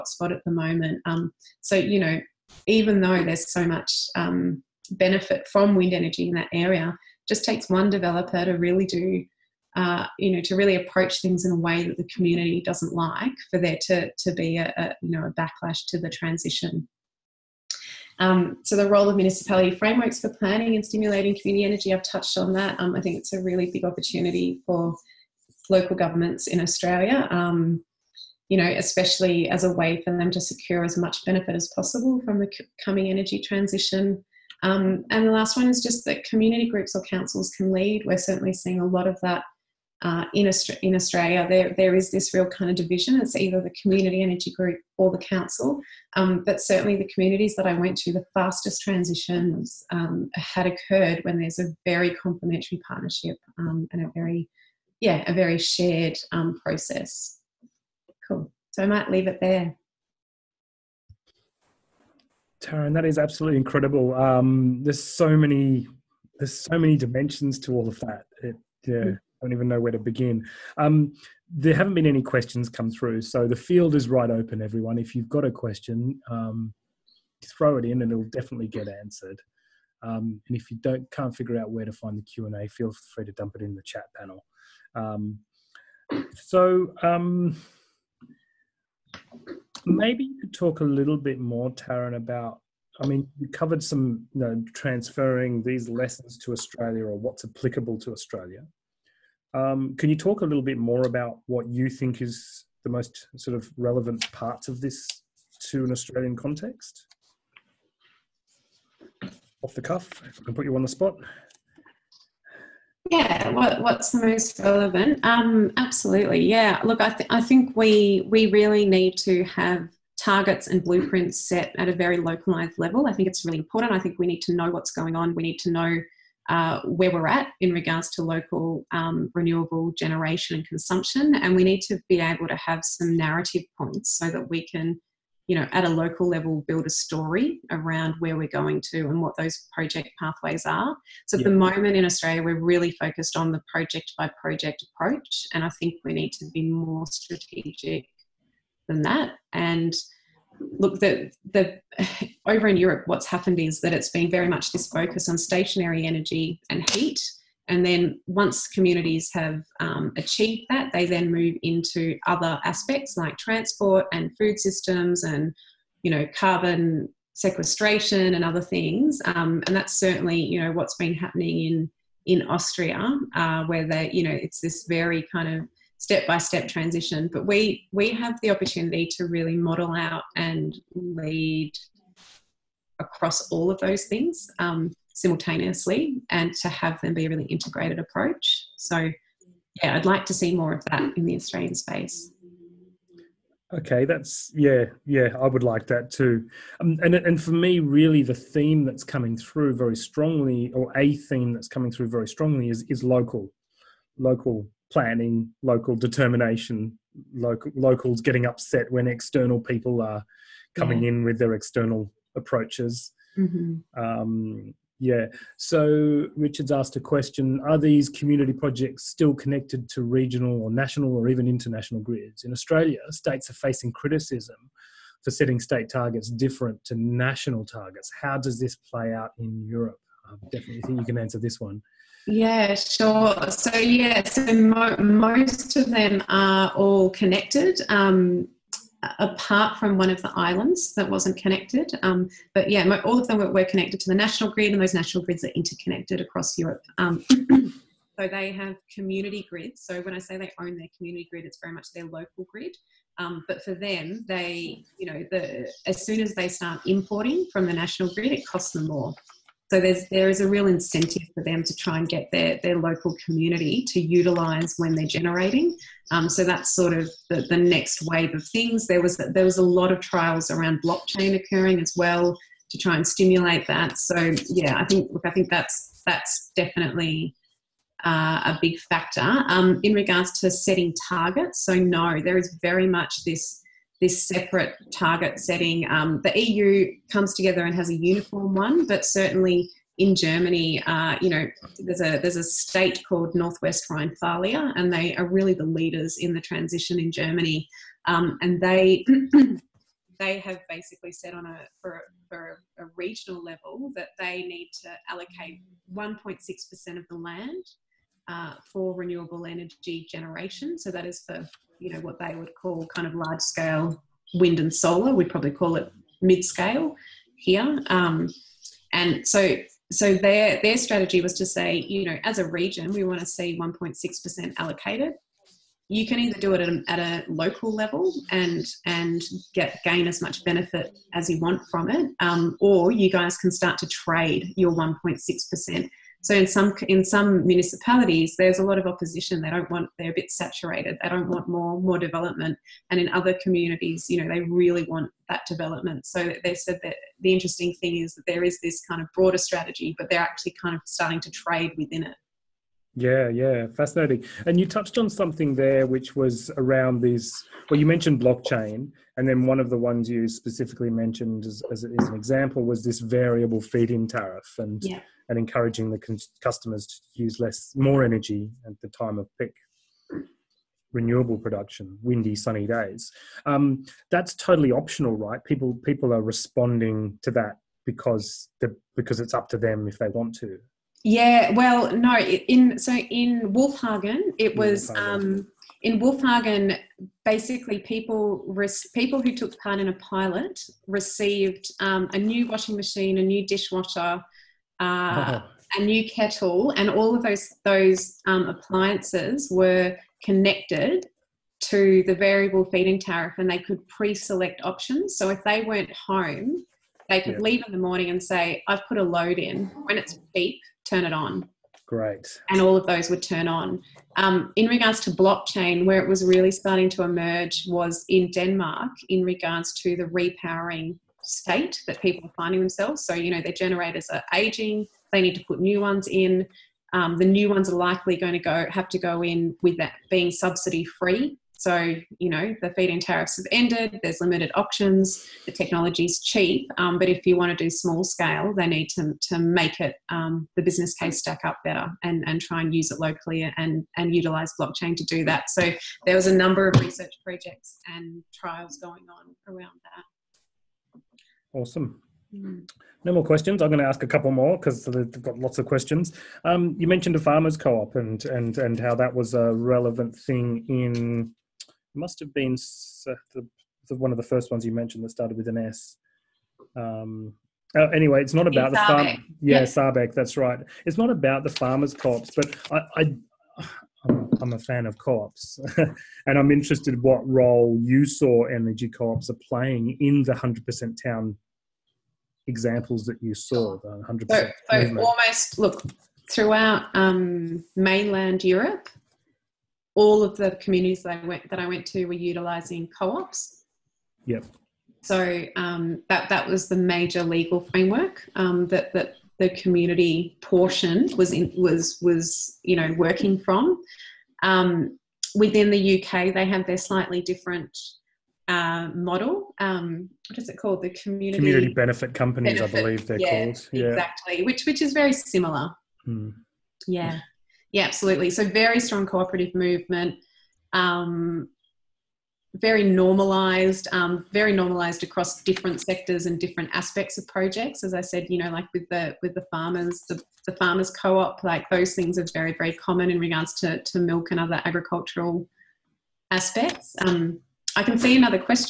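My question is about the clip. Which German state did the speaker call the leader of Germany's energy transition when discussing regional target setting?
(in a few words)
Northwest Rhine-Thalia.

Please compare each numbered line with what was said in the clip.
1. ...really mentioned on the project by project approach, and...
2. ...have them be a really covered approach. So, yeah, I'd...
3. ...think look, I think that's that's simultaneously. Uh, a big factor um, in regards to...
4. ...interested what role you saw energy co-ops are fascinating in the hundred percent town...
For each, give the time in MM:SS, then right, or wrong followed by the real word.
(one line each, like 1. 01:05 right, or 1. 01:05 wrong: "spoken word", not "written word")
1. 02:22 wrong: "focused", not "mentioned"
2. 03:06 wrong: "integrated", not "covered"
3. 04:34 wrong: "definitely", not "simultaneously"
4. 07:56 wrong: "playing", not "fascinating".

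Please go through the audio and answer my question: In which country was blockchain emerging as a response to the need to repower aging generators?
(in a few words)
Denmark.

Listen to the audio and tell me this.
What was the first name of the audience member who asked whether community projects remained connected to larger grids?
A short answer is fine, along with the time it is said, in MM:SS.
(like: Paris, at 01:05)
Richard, at 03:36.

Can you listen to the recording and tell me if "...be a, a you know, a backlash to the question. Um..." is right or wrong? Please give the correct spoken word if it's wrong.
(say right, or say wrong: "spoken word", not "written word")
wrong: "transition", not "question".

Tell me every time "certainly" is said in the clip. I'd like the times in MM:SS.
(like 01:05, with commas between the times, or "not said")
00:38, 00:46, 02:49, 04:49.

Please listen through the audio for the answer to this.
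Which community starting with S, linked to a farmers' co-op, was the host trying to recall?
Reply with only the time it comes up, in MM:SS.
07:49.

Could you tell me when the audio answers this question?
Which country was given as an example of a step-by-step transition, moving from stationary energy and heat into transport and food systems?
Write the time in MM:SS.
02:52.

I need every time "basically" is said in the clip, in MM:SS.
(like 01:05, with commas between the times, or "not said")
05:00, 06:27.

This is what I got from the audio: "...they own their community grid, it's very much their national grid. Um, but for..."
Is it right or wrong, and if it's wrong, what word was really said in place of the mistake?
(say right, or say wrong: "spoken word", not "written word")
wrong: "local", not "national".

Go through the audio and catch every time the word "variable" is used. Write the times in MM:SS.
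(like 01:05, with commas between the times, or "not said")
06:02, 06:42.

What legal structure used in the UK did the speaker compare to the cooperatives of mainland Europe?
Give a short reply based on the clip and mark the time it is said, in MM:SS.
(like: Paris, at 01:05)
community benefit companies, at 08:31.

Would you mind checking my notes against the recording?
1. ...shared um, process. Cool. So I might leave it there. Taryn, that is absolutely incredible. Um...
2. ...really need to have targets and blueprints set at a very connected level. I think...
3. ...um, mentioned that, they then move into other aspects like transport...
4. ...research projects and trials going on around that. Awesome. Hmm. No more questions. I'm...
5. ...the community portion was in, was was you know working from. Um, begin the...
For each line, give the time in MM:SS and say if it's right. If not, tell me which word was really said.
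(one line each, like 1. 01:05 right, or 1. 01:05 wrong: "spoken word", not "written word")
1. 00:55 right
2. 01:58 wrong: "localized", not "connected"
3. 02:39 wrong: "achieved", not "mentioned"
4. 07:26 right
5. 08:19 wrong: "within", not "begin".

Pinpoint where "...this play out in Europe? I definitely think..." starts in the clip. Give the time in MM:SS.
03:48.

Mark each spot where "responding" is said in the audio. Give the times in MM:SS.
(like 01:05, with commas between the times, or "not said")
06:16.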